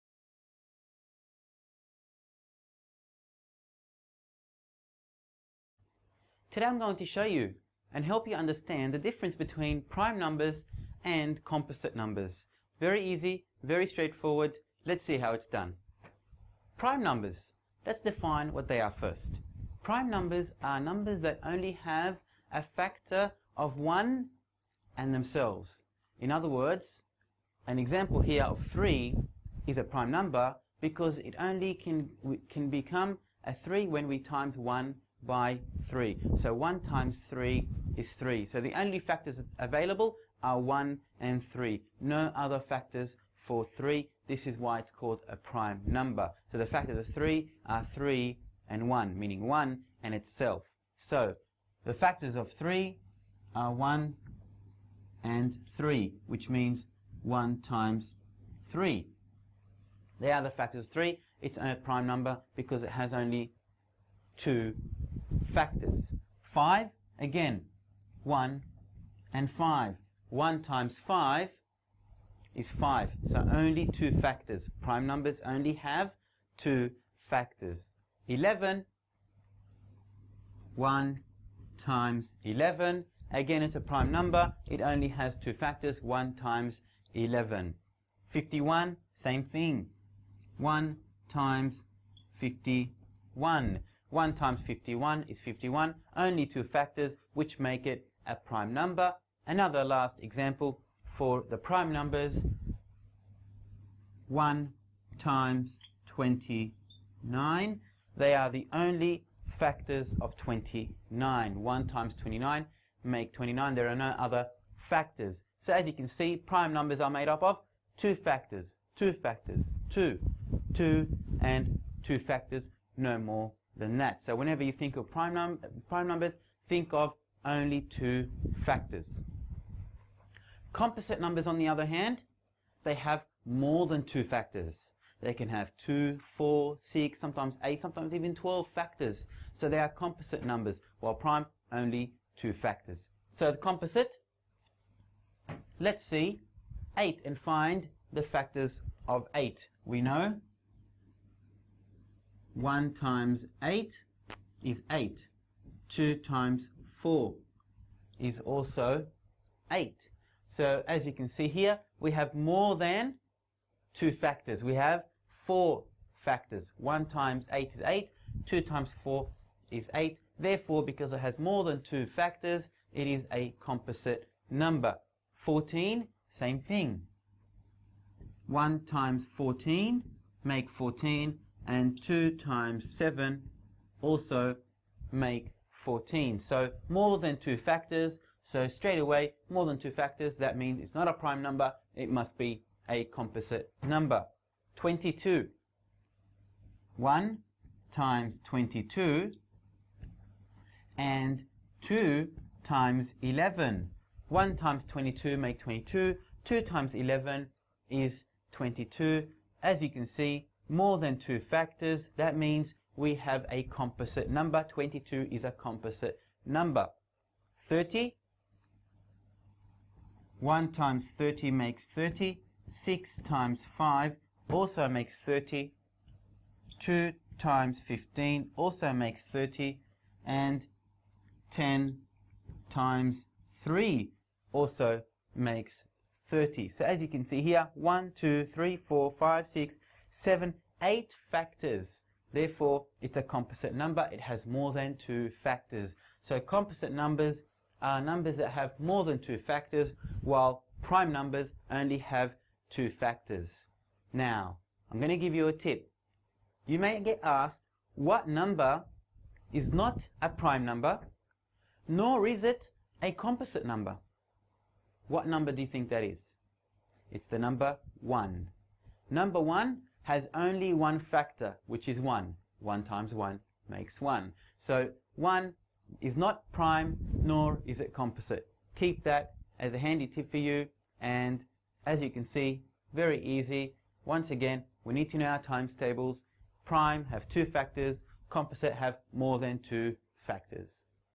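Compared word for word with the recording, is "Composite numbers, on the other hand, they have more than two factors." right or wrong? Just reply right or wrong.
right.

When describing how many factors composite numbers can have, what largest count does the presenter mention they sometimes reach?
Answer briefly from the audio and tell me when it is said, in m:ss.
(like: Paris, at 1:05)
12, at 2:18.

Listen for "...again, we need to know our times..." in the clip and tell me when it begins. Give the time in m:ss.
4:44.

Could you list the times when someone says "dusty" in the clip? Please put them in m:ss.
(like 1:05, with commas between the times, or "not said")
not said.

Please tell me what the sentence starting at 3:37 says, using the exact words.
30, 1 times 30 makes 30.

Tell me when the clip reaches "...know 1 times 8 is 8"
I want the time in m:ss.
2:30.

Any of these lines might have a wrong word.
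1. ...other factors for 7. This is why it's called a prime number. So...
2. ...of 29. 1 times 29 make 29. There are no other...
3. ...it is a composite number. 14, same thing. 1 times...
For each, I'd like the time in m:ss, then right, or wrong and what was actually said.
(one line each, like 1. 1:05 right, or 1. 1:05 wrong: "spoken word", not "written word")
1. 0:42 wrong: "3", not "7"
2. 1:50 right
3. 2:52 right.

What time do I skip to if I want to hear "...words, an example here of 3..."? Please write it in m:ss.
0:26.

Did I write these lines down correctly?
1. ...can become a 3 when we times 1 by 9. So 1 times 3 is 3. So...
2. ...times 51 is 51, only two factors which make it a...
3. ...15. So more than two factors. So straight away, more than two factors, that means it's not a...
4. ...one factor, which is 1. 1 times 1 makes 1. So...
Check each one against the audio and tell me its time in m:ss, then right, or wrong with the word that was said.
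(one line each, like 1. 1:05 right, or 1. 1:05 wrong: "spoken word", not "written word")
1. 0:32 wrong: "3", not "9"
2. 1:34 right
3. 3:05 wrong: "14", not "15"
4. 4:30 right.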